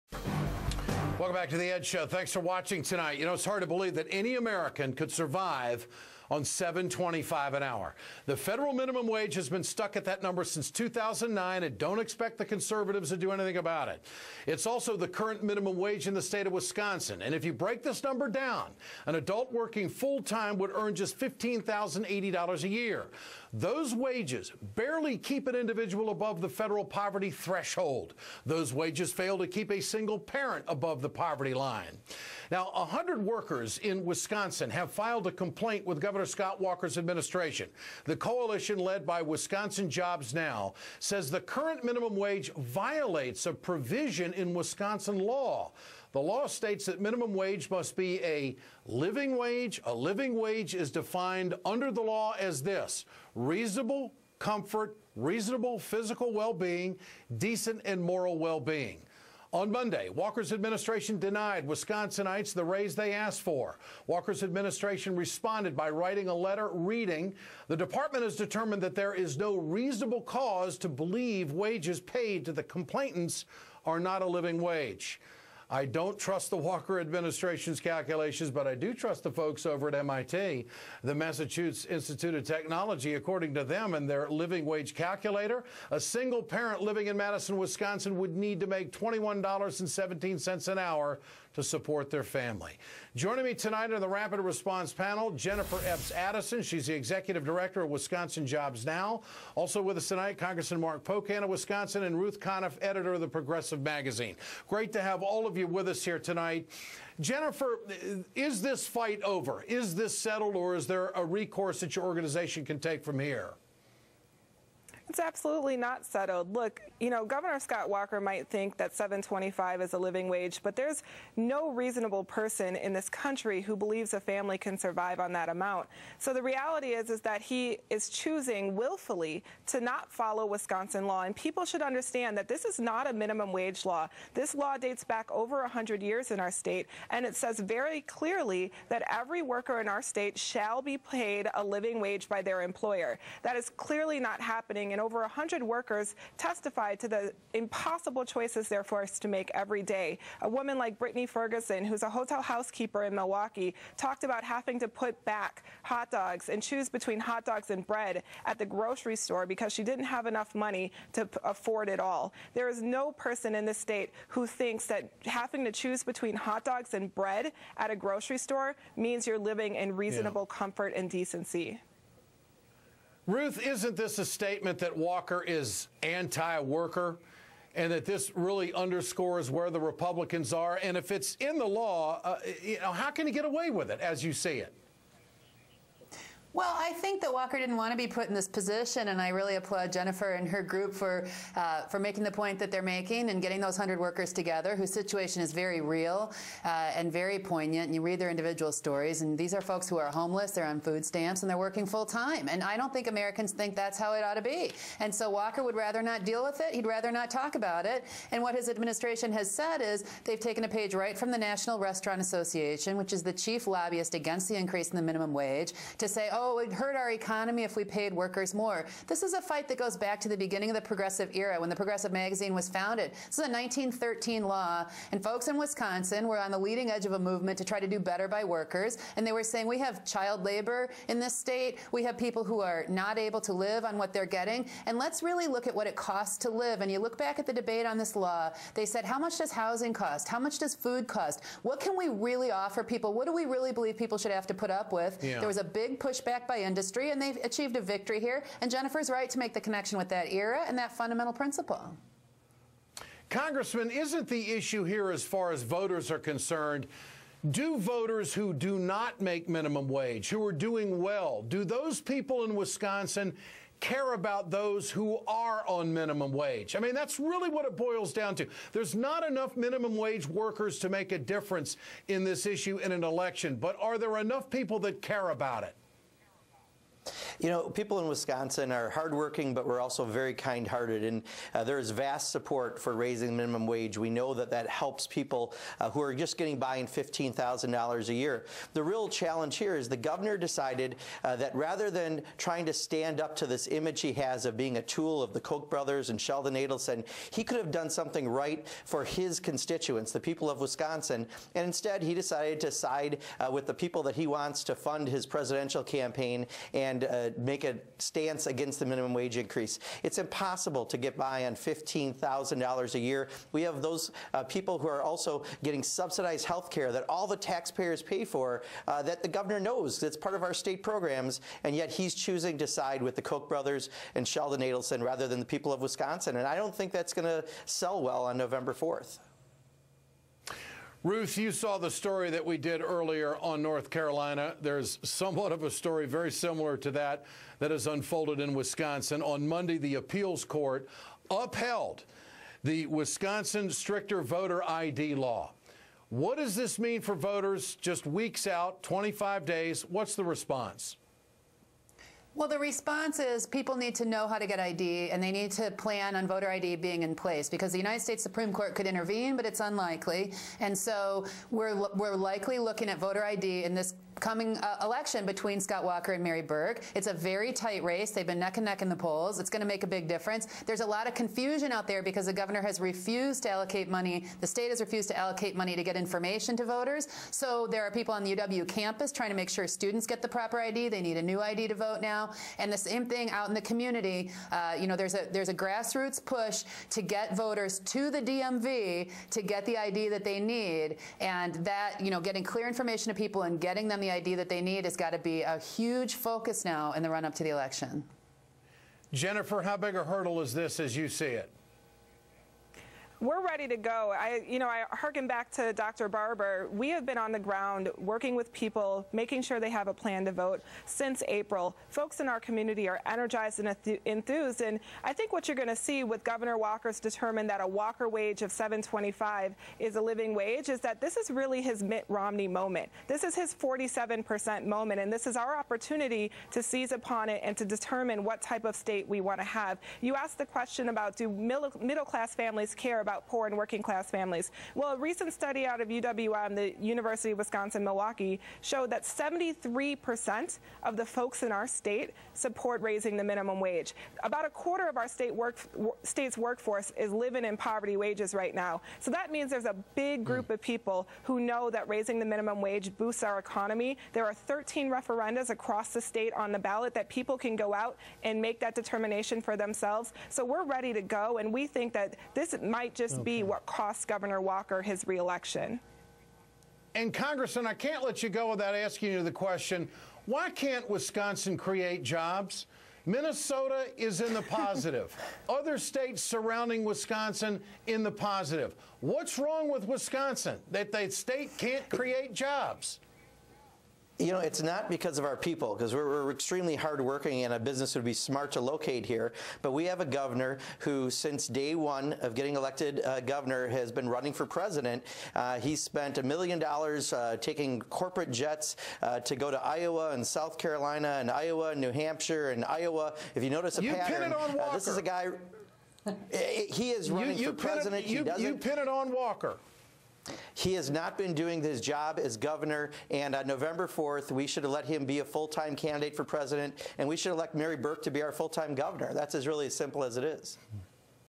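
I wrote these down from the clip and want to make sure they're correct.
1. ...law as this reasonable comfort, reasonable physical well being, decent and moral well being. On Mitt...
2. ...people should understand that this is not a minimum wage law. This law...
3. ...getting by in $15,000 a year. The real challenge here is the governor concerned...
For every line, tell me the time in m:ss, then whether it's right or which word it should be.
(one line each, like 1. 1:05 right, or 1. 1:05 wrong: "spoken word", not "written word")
1. 0:52 wrong: "Monday", not "Mitt"
2. 2:11 right
3. 4:46 wrong: "decided", not "concerned".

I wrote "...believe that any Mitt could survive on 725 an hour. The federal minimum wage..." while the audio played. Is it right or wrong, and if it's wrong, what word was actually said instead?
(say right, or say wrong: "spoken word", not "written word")
wrong: "American", not "Mitt".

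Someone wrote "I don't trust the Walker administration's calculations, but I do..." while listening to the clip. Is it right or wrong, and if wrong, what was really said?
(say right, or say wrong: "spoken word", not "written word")
right.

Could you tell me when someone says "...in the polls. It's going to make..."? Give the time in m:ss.
6:08.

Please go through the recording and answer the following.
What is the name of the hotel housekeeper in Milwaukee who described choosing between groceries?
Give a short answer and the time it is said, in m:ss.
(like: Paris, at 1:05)
Brittany Ferguson, at 2:30.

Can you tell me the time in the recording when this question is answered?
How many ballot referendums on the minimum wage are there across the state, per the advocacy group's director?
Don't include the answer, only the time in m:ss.
7:34.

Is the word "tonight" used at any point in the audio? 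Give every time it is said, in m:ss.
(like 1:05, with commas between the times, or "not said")
0:02, 1:33, 1:40, 1:46.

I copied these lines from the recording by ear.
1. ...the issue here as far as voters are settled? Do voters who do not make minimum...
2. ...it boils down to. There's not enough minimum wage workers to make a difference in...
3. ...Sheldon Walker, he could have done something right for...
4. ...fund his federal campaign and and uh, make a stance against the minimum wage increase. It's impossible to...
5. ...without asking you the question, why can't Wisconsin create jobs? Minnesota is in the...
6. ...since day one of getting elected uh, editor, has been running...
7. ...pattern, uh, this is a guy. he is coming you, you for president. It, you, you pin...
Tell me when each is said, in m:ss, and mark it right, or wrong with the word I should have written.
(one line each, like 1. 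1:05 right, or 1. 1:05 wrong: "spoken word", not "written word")
1. 4:14 wrong: "concerned", not "settled"
2. 4:27 right
3. 4:56 wrong: "Adelson", not "Walker"
4. 5:04 wrong: "presidential", not "federal"
5. 7:48 right
6. 8:11 wrong: "governor", not "editor"
7. 8:23 wrong: "running", not "coming".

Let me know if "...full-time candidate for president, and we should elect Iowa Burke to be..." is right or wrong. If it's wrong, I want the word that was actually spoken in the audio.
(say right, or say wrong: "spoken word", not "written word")
wrong: "Mary", not "Iowa".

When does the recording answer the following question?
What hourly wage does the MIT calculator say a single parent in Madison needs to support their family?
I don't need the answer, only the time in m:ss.
1:28.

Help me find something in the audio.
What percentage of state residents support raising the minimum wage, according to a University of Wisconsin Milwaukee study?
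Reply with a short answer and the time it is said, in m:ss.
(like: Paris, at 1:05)
73%, at 7:19.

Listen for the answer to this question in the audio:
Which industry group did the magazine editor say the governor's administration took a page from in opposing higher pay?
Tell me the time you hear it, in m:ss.
3:31.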